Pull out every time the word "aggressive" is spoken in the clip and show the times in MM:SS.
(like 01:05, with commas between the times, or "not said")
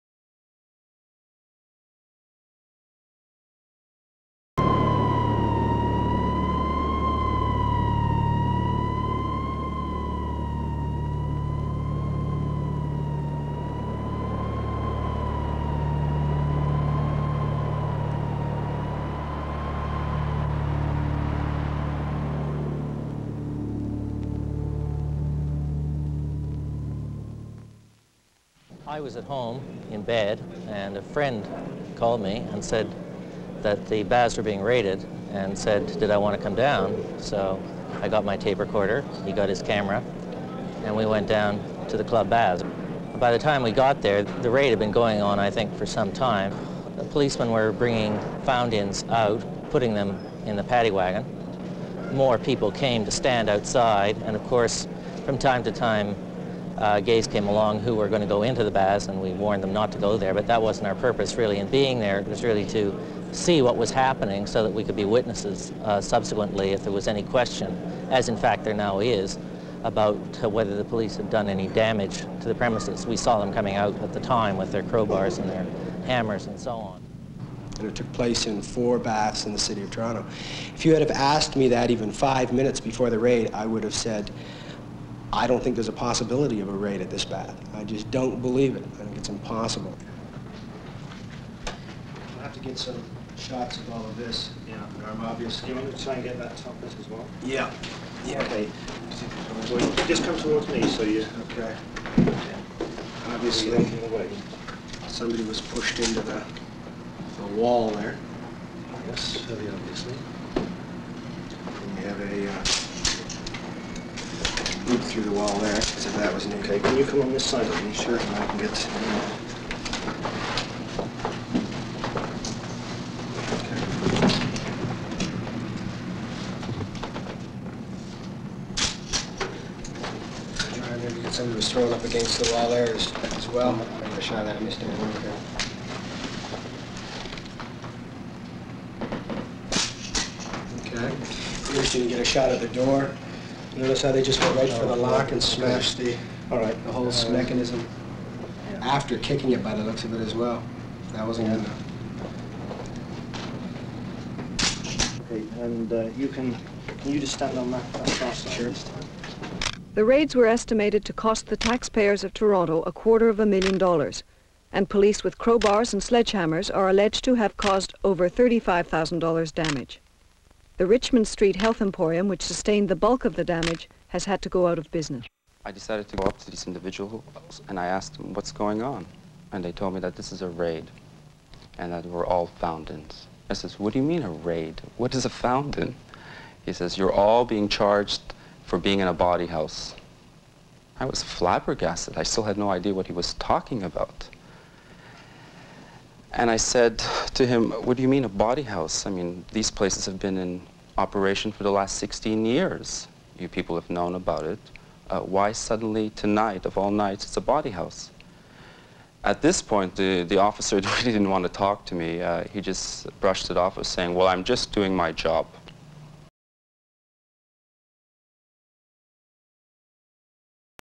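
not said.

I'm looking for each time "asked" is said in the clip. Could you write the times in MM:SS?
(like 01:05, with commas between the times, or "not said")
01:21, 02:57.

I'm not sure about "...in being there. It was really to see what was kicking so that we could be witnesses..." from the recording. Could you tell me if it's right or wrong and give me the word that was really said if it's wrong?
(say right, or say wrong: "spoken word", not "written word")
wrong: "happening", not "kicking".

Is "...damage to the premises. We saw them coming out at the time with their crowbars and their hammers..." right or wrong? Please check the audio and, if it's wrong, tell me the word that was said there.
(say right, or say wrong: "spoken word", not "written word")
right.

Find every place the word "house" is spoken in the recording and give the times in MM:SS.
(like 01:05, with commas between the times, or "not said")
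03:09, 03:18, 03:27.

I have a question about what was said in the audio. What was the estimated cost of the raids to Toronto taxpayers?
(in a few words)
a quarter of a million dollars.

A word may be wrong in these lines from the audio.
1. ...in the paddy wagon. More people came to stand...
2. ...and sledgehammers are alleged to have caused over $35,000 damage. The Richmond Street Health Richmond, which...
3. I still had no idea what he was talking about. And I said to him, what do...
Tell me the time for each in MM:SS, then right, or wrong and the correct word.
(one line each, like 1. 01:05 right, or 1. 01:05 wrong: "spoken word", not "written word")
1. 00:50 right
2. 02:45 wrong: "Emporium", not "Richmond"
3. 03:12 right.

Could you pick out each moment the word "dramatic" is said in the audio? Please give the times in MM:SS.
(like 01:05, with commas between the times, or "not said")
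not said.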